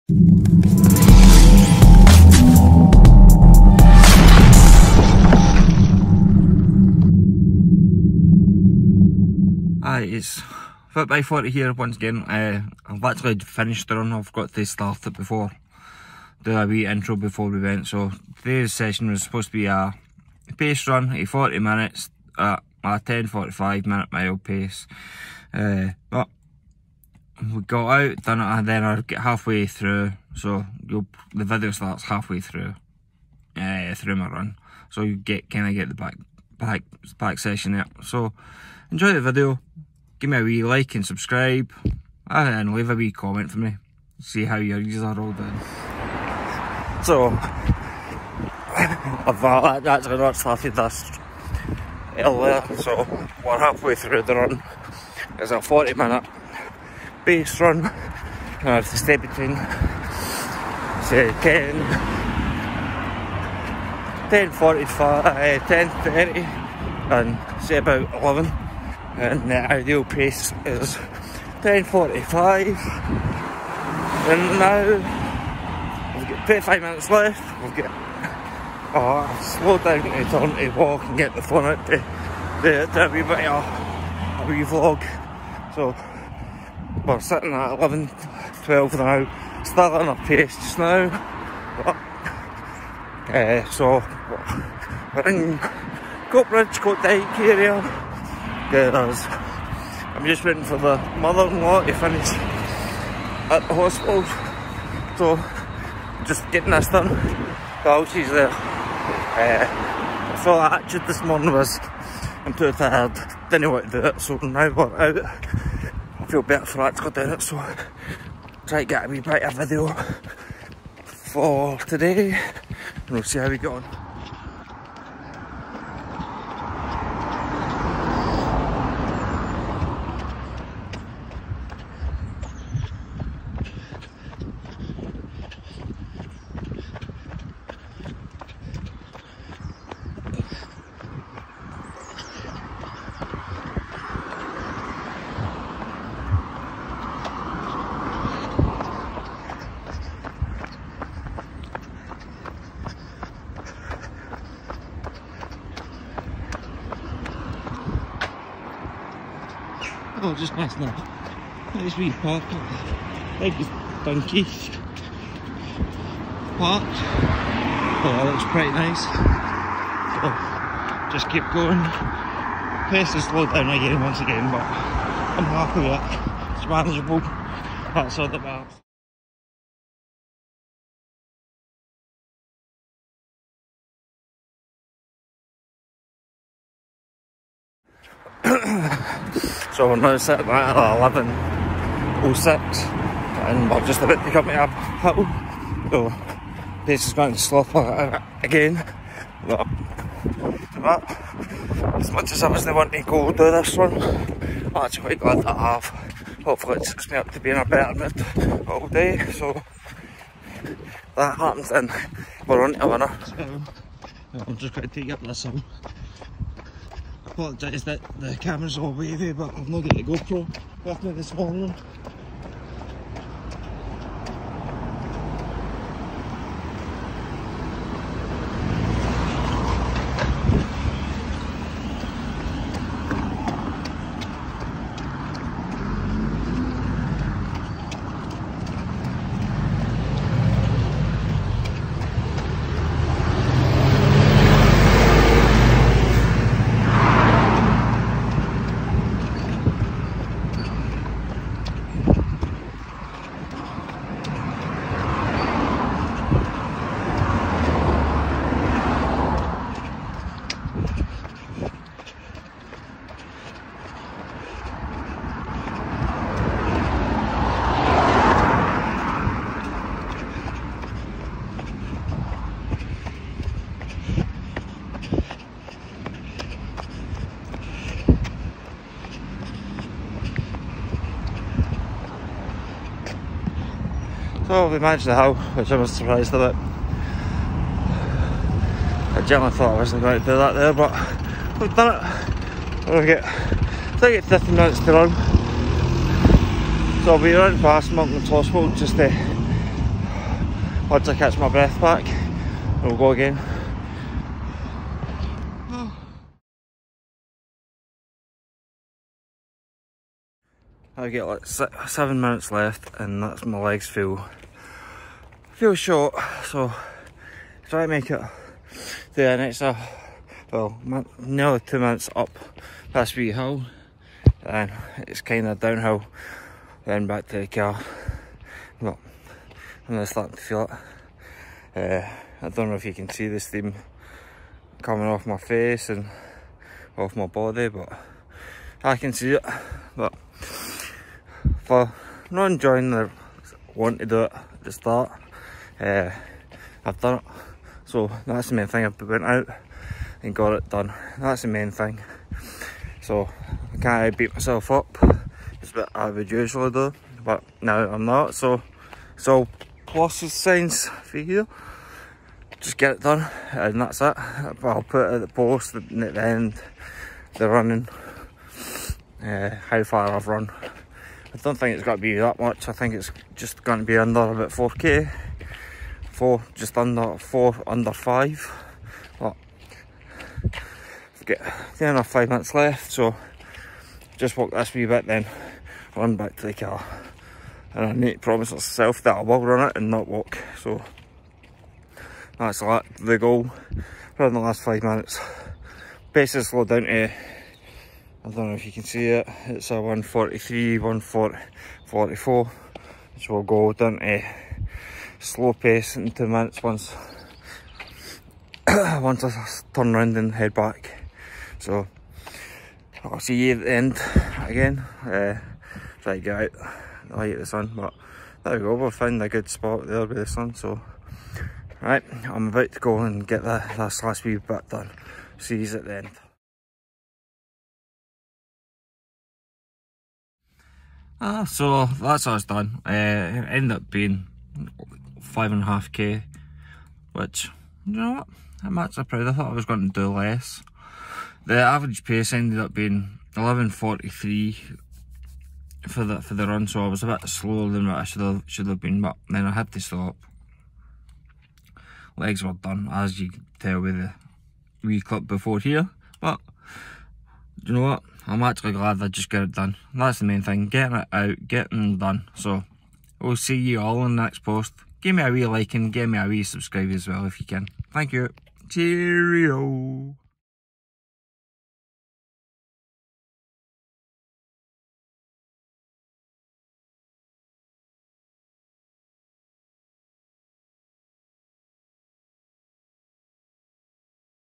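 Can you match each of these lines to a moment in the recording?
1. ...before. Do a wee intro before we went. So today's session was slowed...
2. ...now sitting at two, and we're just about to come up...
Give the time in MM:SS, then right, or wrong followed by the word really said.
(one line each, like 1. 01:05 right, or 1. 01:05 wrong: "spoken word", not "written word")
1. 00:15 wrong: "supposed", not "slowed"
2. 03:09 wrong: "six", not "two".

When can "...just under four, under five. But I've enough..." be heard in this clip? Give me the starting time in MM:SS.
06:16.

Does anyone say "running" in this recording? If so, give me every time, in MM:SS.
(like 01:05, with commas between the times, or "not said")
04:57, 06:07.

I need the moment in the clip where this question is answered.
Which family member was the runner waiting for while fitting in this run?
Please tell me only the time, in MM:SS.
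01:41.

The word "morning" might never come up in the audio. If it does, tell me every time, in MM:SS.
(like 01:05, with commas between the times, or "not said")
01:51, 03:41.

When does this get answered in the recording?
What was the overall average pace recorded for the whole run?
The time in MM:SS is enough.
07:23.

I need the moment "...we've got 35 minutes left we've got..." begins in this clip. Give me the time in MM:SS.
01:16.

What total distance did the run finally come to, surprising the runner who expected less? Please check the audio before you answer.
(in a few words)
5.5 km.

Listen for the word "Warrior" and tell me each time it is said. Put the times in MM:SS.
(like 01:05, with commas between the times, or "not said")
not said.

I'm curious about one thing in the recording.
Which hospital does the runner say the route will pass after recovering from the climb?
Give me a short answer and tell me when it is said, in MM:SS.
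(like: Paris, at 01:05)
Monklands Hospital, at 04:57.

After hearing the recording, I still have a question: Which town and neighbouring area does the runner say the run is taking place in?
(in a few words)
Coatbridge, Coatdyke.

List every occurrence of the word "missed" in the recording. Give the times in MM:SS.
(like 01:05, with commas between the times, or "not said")
not said.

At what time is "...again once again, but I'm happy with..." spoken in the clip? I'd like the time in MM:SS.
02:53.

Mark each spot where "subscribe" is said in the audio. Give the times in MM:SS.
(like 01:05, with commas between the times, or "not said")
00:41, 07:46.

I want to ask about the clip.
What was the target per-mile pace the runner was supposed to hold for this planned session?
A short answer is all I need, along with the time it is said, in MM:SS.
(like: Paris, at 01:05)
10:45, at 00:22.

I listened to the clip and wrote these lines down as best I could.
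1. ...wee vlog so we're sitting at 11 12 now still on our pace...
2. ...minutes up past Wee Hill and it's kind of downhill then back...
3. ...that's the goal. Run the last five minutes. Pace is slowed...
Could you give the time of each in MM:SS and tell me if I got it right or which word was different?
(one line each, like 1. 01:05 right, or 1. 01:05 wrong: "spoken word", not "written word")
1. 01:24 right
2. 05:21 right
3. 06:32 right.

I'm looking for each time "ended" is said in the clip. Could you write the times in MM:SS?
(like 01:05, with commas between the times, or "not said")
07:13, 07:22.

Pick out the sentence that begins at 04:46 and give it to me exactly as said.
I generally thought I wasn't going to do that there, but we've done it.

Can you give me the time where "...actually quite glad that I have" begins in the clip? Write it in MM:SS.
03:24.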